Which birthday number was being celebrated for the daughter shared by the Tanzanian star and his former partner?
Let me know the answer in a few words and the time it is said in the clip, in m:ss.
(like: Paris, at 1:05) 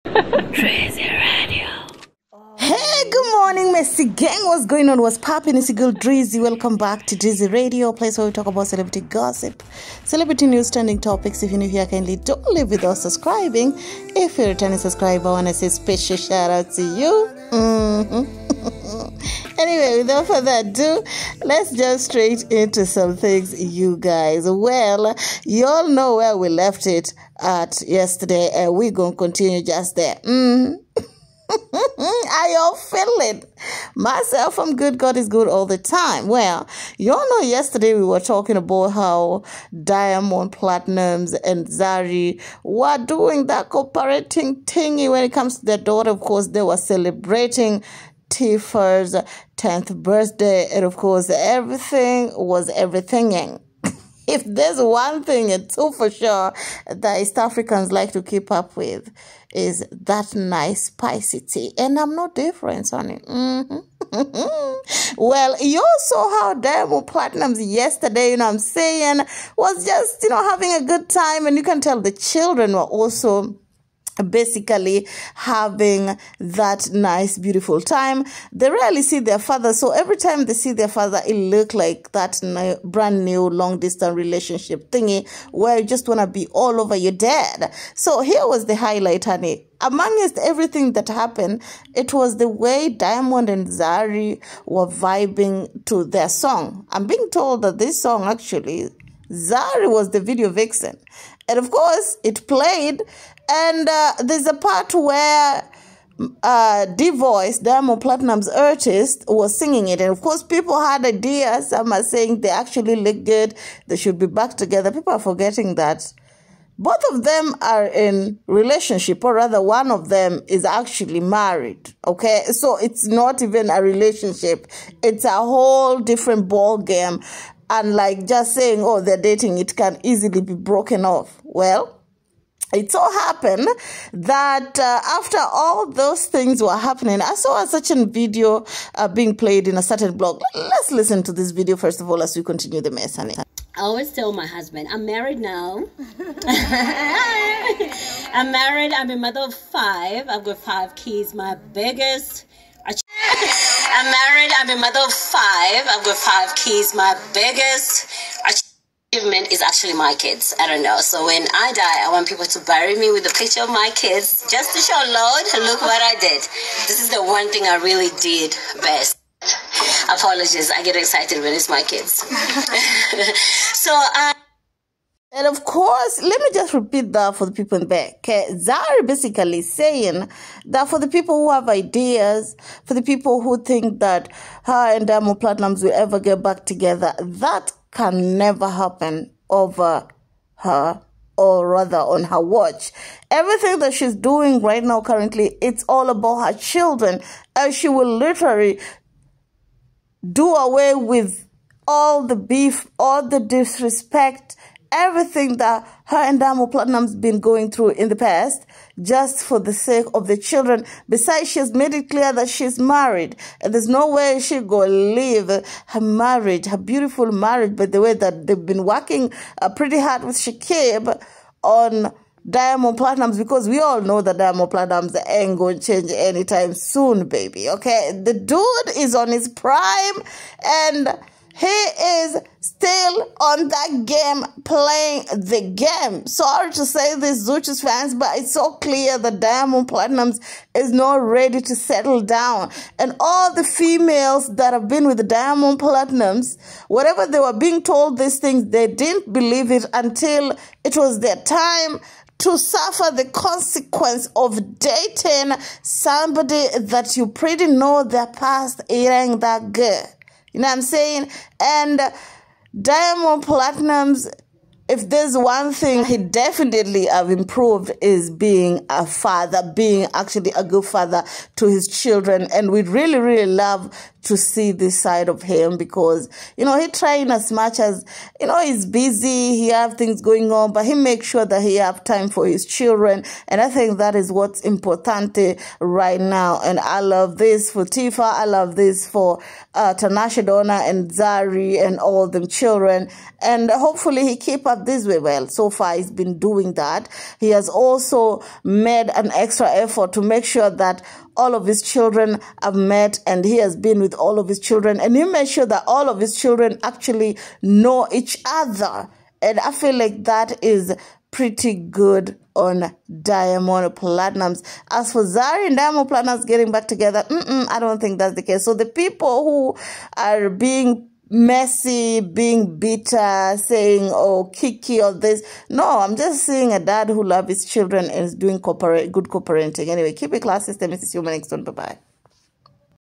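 10th, at 0:49.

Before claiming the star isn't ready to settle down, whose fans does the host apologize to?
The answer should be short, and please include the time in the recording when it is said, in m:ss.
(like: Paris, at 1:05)
Zuchu, at 3:57.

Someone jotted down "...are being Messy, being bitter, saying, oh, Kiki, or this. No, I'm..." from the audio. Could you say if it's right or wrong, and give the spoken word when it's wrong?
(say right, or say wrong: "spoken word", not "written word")
right.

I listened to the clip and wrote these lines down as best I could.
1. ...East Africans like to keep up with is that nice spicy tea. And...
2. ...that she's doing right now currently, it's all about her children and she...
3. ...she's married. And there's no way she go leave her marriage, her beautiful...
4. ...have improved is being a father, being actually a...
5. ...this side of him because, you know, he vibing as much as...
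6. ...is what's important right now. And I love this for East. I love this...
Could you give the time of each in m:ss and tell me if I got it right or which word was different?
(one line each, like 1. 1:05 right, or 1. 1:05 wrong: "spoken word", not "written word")
1. 0:57 right
2. 3:13 right
3. 3:32 right
4. 4:27 right
5. 4:34 wrong: "trying", not "vibing"
6. 4:44 wrong: "Tiffah", not "East".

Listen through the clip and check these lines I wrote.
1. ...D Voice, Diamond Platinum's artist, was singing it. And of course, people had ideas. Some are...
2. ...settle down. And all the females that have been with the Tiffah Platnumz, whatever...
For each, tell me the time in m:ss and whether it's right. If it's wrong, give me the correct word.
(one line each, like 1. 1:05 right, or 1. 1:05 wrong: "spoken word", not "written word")
1. 1:46 right
2. 4:01 wrong: "Diamond", not "Tiffah".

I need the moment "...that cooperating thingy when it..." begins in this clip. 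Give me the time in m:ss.
0:43.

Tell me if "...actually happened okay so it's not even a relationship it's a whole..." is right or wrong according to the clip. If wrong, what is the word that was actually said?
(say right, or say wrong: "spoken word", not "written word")
wrong: "married", not "happened".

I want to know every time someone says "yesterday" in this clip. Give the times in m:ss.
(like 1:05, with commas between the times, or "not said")
0:27, 0:37, 1:07.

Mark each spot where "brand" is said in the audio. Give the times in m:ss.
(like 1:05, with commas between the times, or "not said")
1:22.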